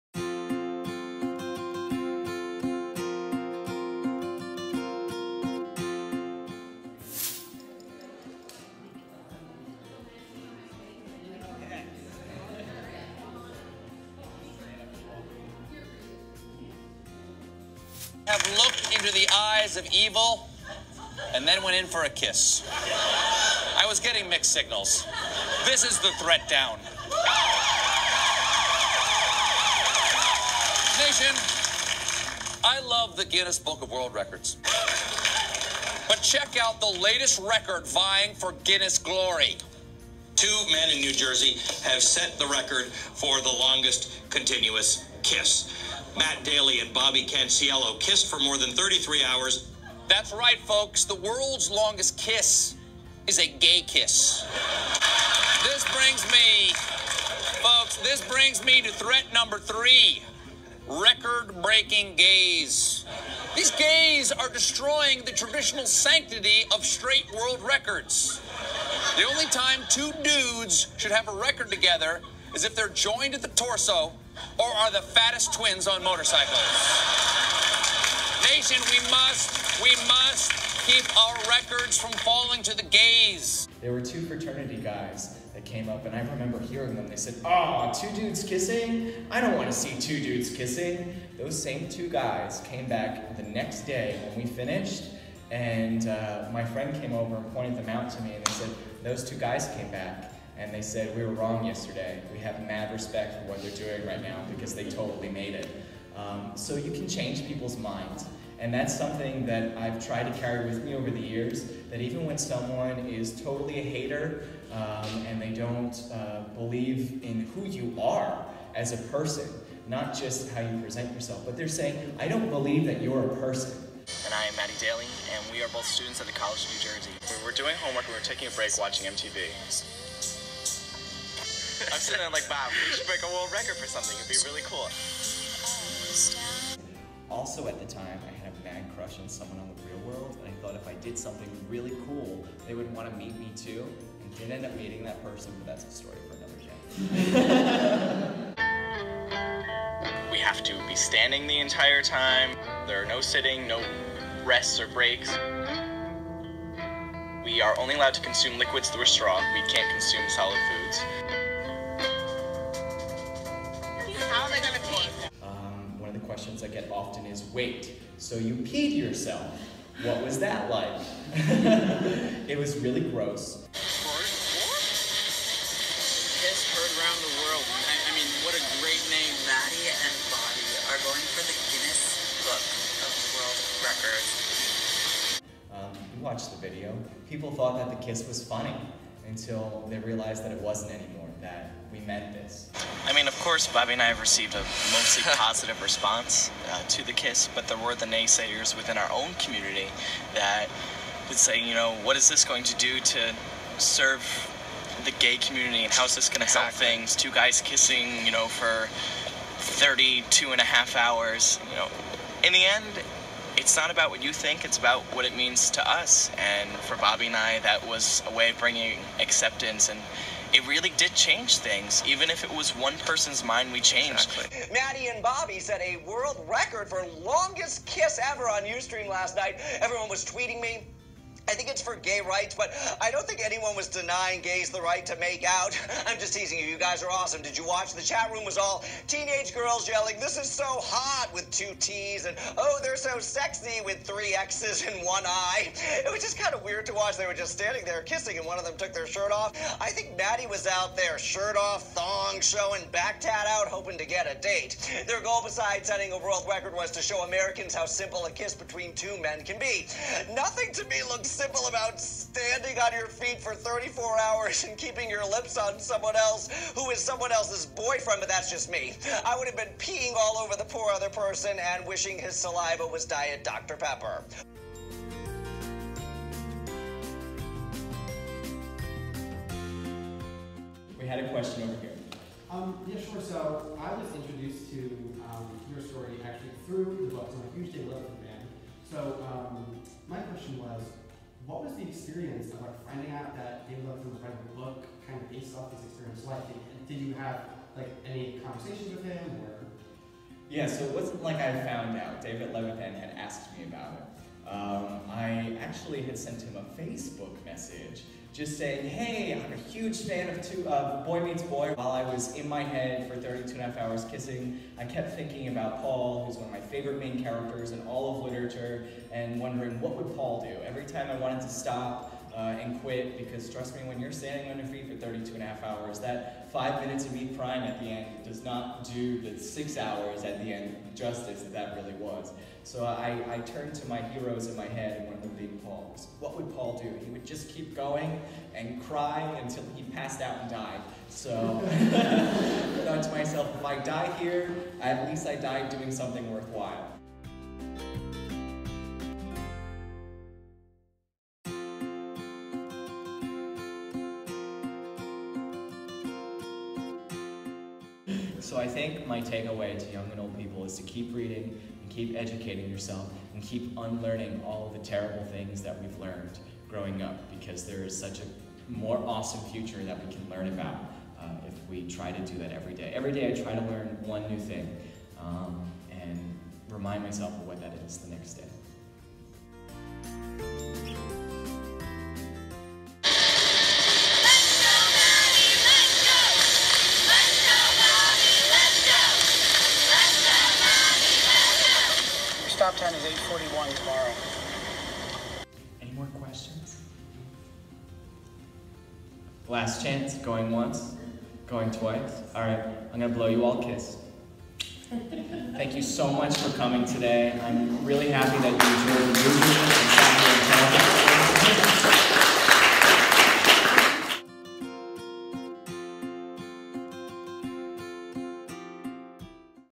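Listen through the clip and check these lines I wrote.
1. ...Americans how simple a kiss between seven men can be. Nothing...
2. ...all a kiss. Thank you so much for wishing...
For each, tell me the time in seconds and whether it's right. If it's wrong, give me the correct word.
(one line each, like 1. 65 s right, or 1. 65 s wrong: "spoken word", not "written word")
1. 257 s wrong: "two", not "seven"
2. 403 s wrong: "coming", not "wishing".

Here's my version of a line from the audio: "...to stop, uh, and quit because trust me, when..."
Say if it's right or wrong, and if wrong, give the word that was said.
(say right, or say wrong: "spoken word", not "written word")
right.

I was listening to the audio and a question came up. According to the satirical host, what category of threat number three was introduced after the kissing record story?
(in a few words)
Record breaking gays.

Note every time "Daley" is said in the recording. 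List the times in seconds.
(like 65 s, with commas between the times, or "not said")
46 s, 124 s.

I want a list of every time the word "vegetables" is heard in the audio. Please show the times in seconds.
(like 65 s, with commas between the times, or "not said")
not said.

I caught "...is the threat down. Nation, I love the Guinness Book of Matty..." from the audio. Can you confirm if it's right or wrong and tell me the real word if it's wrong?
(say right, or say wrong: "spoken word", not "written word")
wrong: "World", not "Matty".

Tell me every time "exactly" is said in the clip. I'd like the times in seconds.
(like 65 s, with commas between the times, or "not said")
206 s, 224 s.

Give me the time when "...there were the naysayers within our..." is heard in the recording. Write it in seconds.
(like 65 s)
197 s.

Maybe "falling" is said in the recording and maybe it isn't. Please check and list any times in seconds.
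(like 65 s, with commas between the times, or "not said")
82 s.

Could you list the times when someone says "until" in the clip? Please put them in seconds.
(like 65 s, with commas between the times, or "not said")
189 s, 339 s.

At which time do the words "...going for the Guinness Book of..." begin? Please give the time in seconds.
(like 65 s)
181 s.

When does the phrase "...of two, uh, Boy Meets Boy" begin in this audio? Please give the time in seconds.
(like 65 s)
310 s.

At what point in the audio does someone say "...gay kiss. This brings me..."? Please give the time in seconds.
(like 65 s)
53 s.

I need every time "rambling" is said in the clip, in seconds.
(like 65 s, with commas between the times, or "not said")
not said.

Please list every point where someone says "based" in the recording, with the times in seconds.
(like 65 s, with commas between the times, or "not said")
295 s.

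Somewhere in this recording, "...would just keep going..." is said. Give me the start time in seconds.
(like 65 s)
337 s.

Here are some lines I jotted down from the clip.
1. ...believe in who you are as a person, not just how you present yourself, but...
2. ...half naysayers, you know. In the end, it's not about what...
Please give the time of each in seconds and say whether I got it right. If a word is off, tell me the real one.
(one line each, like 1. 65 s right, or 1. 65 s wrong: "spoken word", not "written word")
1. 116 s right
2. 210 s wrong: "hours", not "naysayers".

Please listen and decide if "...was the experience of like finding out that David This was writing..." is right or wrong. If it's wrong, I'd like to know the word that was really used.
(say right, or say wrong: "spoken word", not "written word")
wrong: "Levithan", not "This".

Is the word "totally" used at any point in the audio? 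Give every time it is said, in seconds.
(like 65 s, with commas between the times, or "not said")
104 s, 113 s.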